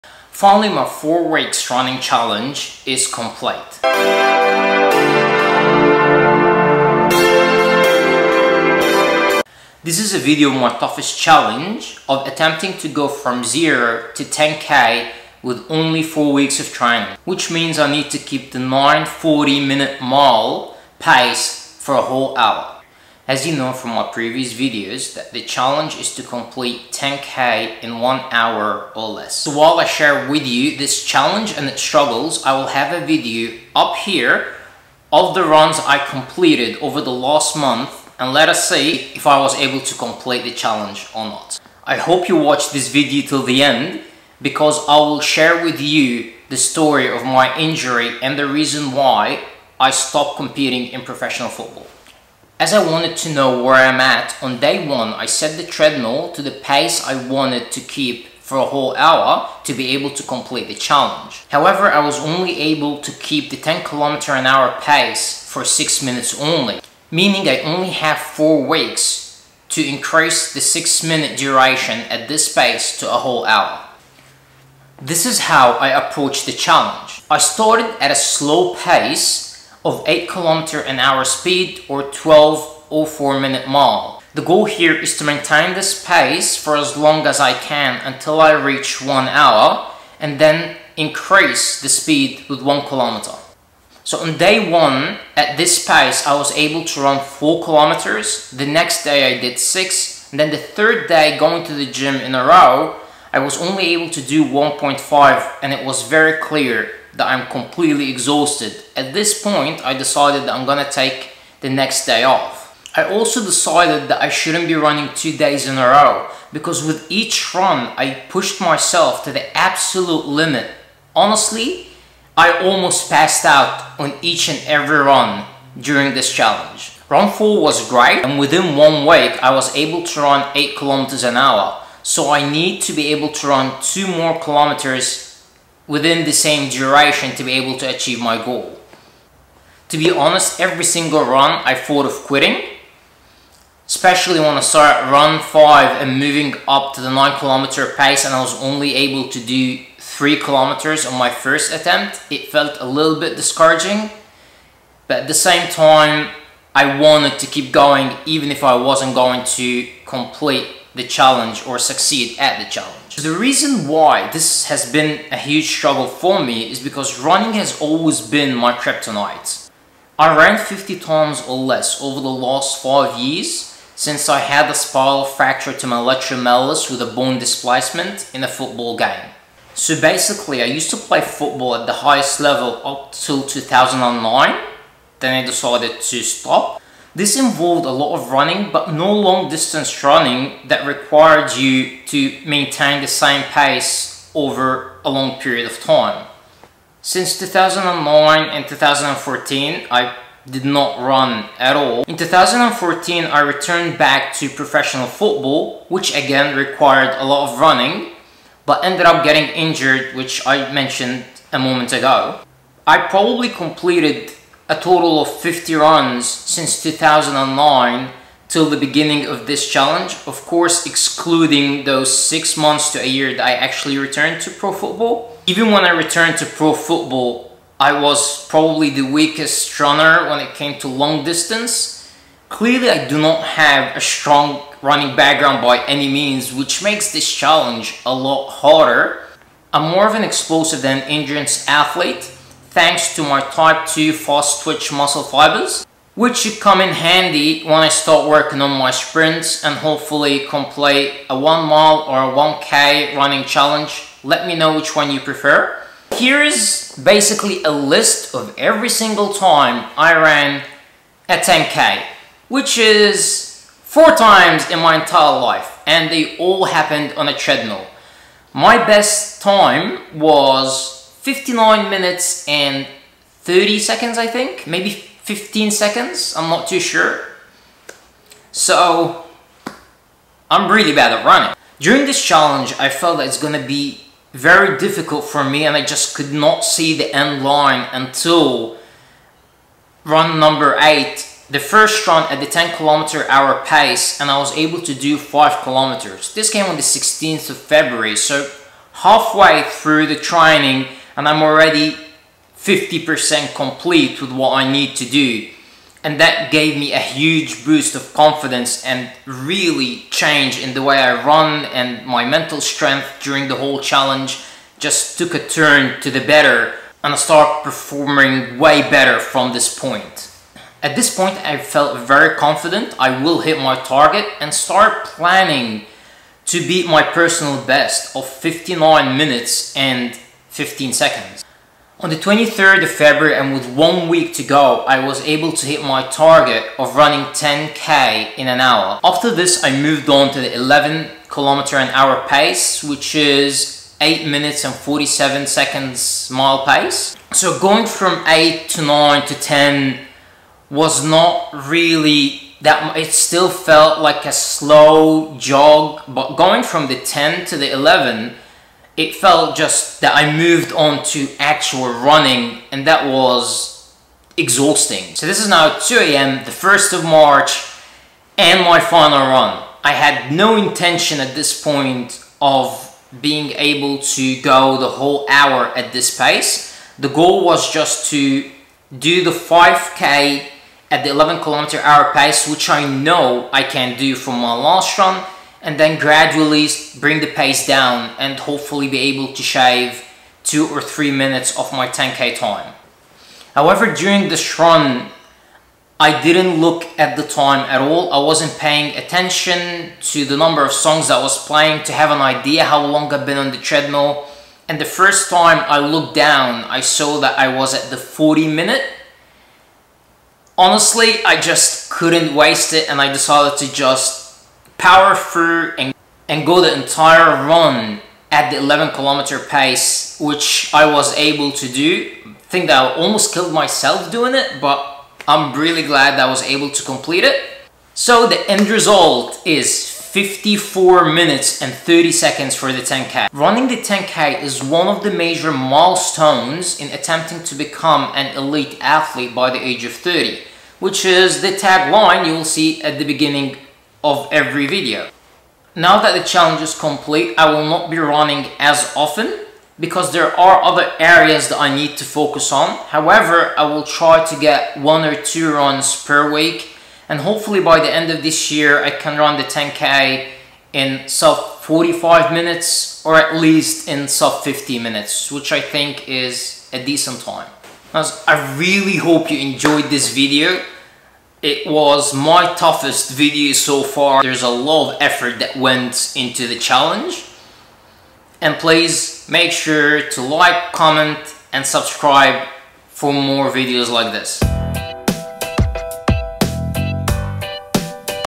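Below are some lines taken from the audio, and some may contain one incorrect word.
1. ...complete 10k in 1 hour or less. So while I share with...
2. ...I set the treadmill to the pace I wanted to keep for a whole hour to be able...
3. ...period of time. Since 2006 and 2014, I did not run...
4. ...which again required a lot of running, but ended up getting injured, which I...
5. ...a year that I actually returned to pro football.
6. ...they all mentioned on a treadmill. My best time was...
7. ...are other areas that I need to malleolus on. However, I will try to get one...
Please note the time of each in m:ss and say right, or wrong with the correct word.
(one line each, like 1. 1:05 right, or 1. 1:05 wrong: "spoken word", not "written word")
1. 0:26 right
2. 0:55 right
3. 3:15 wrong: "2009", not "2006"
4. 3:25 right
5. 3:43 right
6. 4:26 wrong: "happened", not "mentioned"
7. 7:30 wrong: "focus", not "malleolus".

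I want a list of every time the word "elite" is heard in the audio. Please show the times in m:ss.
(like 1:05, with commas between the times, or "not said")
7:18.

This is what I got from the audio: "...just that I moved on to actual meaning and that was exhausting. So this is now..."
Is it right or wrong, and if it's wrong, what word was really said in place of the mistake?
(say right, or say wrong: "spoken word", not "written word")
wrong: "running", not "meaning".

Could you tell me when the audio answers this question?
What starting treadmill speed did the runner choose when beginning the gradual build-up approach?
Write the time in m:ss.
1:20.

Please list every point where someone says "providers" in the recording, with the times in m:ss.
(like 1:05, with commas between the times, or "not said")
not said.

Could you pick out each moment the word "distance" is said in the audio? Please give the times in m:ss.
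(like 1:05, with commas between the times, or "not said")
3:09, 3:51.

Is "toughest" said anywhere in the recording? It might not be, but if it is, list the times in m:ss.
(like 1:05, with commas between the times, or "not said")
0:10, 7:52.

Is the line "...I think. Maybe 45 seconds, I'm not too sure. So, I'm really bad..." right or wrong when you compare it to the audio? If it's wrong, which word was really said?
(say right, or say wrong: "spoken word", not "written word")
wrong: "15", not "45".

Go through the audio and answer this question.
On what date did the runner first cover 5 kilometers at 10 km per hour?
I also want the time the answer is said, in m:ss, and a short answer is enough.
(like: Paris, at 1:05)
16 February, at 4:56.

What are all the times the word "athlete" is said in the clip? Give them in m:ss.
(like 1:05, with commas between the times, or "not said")
4:01, 7:18.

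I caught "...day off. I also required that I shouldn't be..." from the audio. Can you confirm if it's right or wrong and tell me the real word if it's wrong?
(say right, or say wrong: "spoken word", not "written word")
wrong: "decided", not "required".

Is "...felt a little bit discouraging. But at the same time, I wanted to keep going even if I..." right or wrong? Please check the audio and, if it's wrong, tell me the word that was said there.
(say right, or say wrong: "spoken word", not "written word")
right.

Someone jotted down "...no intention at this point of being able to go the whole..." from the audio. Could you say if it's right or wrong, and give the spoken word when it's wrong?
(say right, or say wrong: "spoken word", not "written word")
right.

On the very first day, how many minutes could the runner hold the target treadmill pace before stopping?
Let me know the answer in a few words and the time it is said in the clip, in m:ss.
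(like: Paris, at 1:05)
6 minutes, at 1:05.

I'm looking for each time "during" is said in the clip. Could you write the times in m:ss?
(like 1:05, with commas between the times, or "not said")
2:05, 4:41, 5:13, 6:33.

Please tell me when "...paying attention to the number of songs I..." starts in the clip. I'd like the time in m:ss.
6:38.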